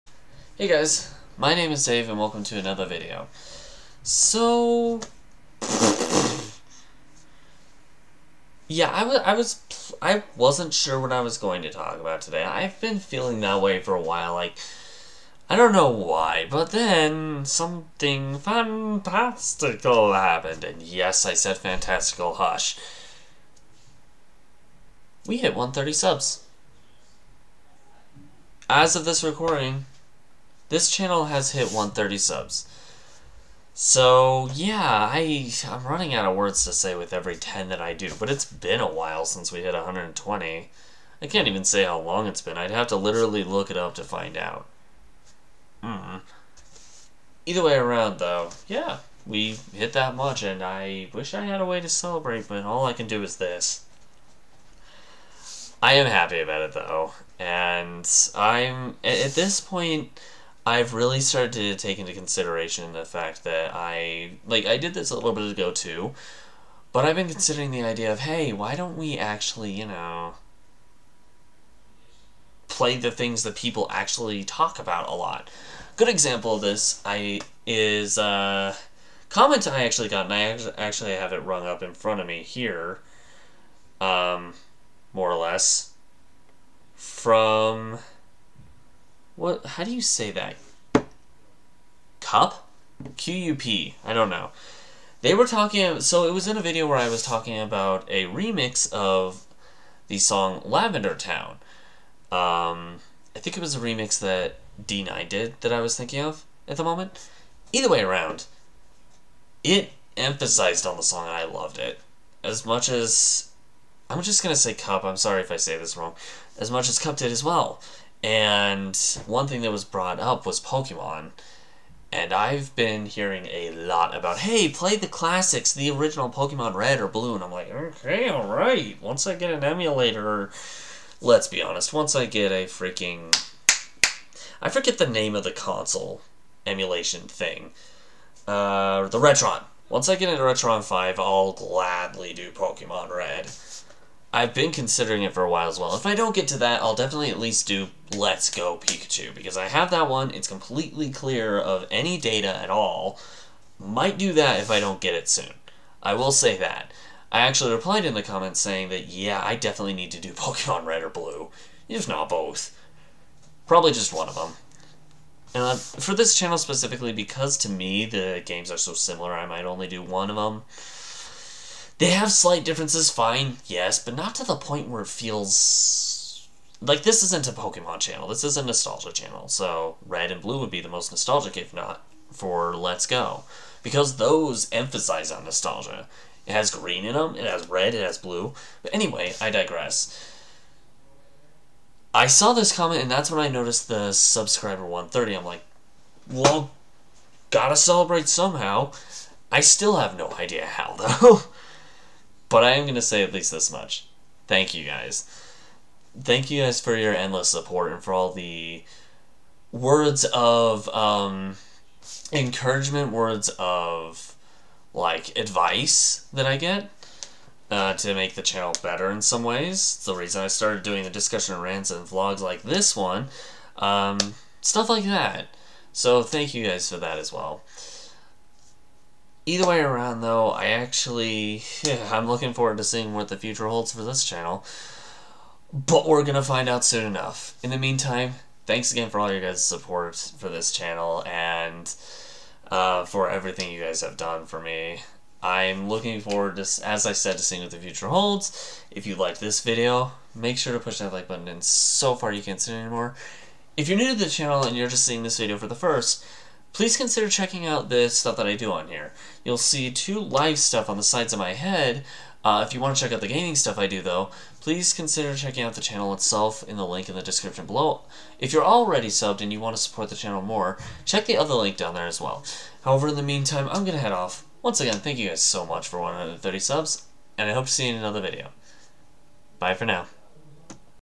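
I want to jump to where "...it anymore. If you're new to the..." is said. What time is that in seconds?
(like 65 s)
252 s.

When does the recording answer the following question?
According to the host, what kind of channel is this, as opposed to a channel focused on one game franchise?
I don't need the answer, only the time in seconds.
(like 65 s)
178 s.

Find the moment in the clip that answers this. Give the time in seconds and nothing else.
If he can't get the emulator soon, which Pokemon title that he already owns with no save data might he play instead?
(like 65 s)
148 s.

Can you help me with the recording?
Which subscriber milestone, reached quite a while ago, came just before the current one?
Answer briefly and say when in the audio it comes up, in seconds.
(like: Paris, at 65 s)
120, at 39 s.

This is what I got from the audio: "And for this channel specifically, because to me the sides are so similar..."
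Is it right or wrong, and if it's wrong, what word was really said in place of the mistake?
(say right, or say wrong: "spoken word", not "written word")
wrong: "games", not "sides".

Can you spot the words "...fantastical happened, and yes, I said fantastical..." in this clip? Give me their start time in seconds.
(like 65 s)
18 s.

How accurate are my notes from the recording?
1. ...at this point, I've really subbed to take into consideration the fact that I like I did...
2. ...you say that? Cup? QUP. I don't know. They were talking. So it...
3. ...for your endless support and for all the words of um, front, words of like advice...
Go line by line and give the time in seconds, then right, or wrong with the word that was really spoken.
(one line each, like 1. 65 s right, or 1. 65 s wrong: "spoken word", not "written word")
1. 59 s wrong: "started", not "subbed"
2. 89 s right
3. 206 s wrong: "encouragement", not "front".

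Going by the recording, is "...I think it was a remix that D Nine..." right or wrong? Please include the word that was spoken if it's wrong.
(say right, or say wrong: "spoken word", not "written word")
right.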